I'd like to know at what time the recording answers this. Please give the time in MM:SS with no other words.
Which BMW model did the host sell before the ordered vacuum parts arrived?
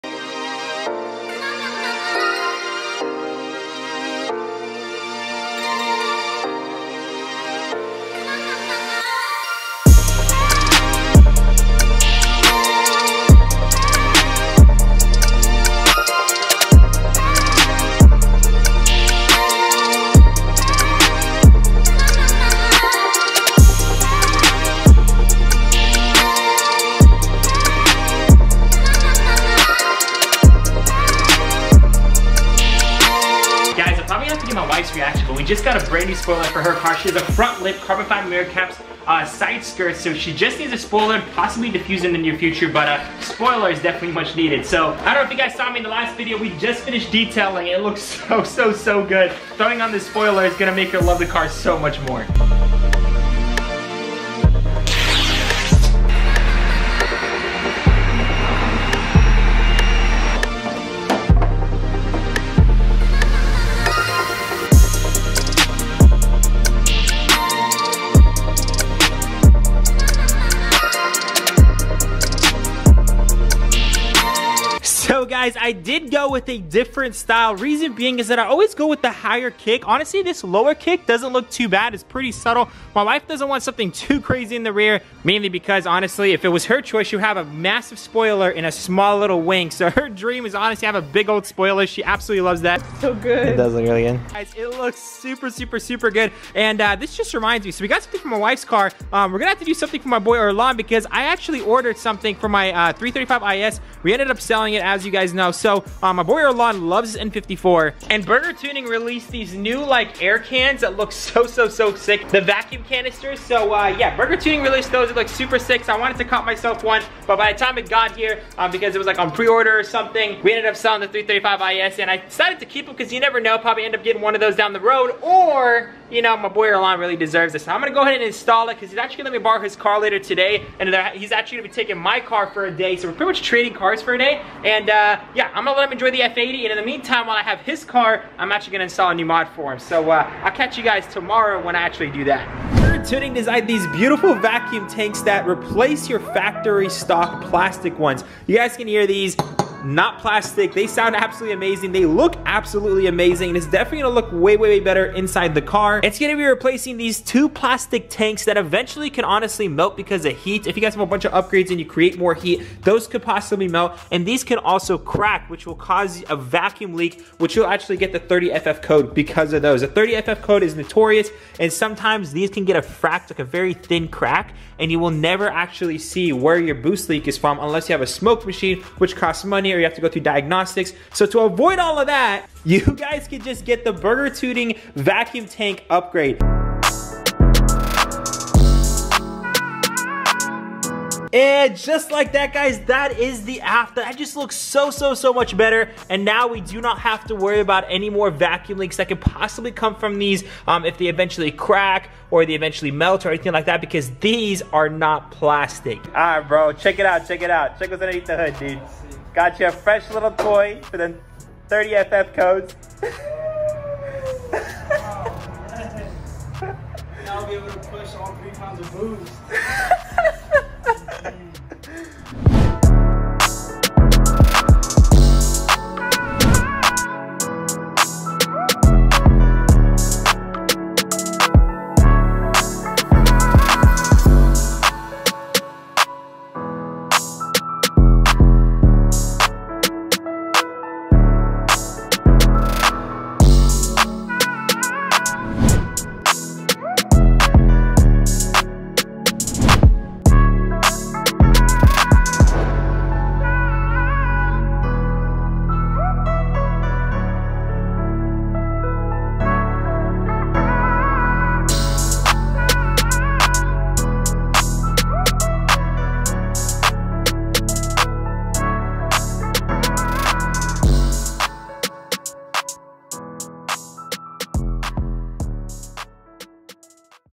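02:01.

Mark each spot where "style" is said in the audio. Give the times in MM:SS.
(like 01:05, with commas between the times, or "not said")
01:17.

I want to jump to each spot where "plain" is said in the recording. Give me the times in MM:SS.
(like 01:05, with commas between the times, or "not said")
not said.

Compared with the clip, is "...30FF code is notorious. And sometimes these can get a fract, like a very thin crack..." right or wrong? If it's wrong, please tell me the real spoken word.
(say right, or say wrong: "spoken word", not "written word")
right.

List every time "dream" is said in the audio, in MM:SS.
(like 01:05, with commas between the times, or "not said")
01:30.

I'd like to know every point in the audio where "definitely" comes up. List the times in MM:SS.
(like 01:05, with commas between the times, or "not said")
00:43, 02:33.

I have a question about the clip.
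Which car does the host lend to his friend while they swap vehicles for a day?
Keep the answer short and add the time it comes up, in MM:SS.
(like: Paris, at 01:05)
F80, at 02:16.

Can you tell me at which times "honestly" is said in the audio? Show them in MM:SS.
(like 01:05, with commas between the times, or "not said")
01:19, 01:25, 01:30, 02:39.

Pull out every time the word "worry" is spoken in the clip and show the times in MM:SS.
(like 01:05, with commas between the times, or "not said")
03:17.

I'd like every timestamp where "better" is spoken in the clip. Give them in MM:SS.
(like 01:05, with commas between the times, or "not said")
02:34, 03:15.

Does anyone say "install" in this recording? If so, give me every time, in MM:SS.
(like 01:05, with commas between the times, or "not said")
02:08, 02:18.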